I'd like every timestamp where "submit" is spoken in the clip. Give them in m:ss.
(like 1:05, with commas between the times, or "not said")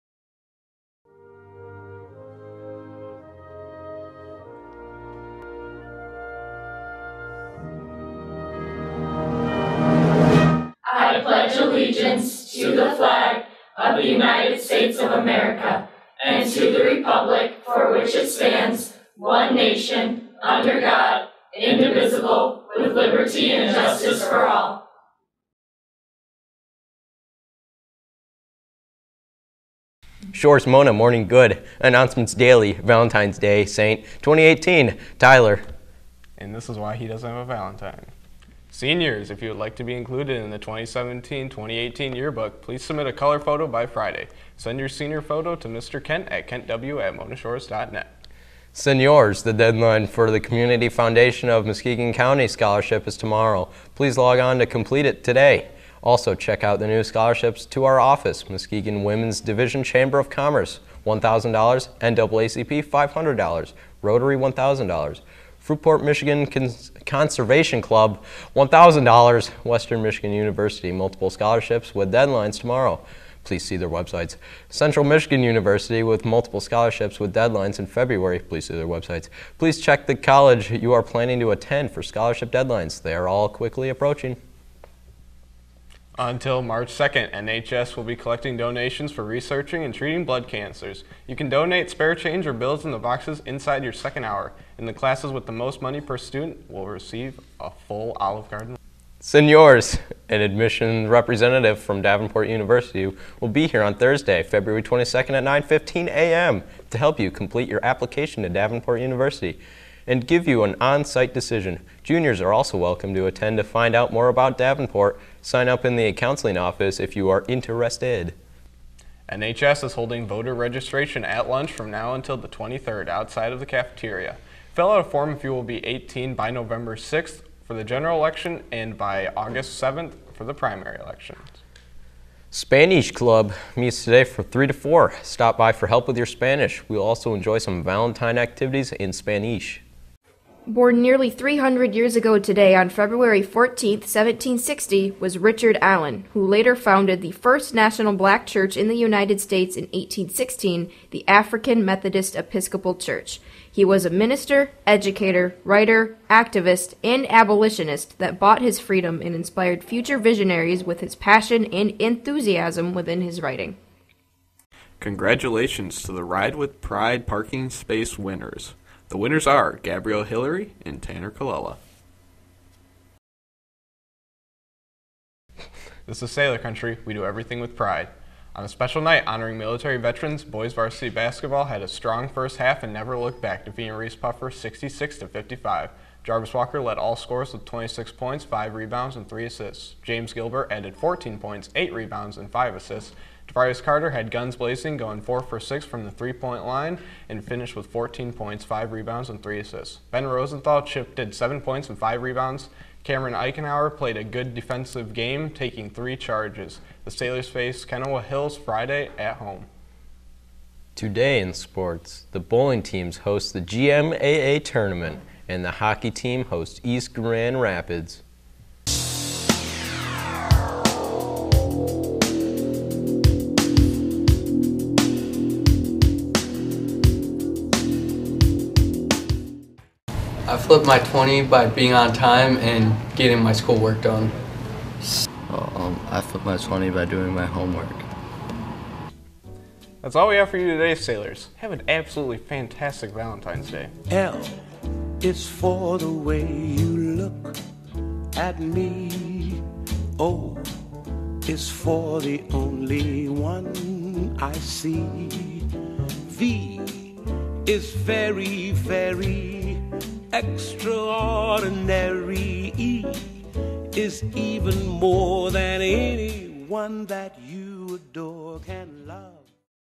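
0:42.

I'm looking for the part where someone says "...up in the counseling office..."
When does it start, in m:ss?
1:55.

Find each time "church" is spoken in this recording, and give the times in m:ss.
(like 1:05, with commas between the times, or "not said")
2:28, 2:32.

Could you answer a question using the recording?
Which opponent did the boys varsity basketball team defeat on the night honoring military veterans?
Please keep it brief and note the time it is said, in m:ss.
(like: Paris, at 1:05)
Reeths-Puffer, at 3:03.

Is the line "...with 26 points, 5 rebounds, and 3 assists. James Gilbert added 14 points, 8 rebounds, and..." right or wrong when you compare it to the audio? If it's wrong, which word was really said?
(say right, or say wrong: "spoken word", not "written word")
right.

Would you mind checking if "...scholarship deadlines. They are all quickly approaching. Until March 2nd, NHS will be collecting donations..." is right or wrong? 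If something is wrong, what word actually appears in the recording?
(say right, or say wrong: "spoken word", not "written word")
right.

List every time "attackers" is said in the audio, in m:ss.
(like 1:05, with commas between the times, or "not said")
not said.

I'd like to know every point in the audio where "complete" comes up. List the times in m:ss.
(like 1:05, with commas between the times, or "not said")
0:54, 1:47.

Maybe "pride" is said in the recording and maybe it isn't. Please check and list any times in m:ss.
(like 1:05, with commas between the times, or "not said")
2:46, 2:57.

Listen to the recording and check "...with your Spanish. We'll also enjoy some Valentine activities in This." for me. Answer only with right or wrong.
wrong.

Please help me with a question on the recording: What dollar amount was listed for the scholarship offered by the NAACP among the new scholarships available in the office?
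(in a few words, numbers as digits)
$500.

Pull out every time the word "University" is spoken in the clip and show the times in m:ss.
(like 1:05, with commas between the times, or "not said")
1:10, 1:15, 1:42, 1:48.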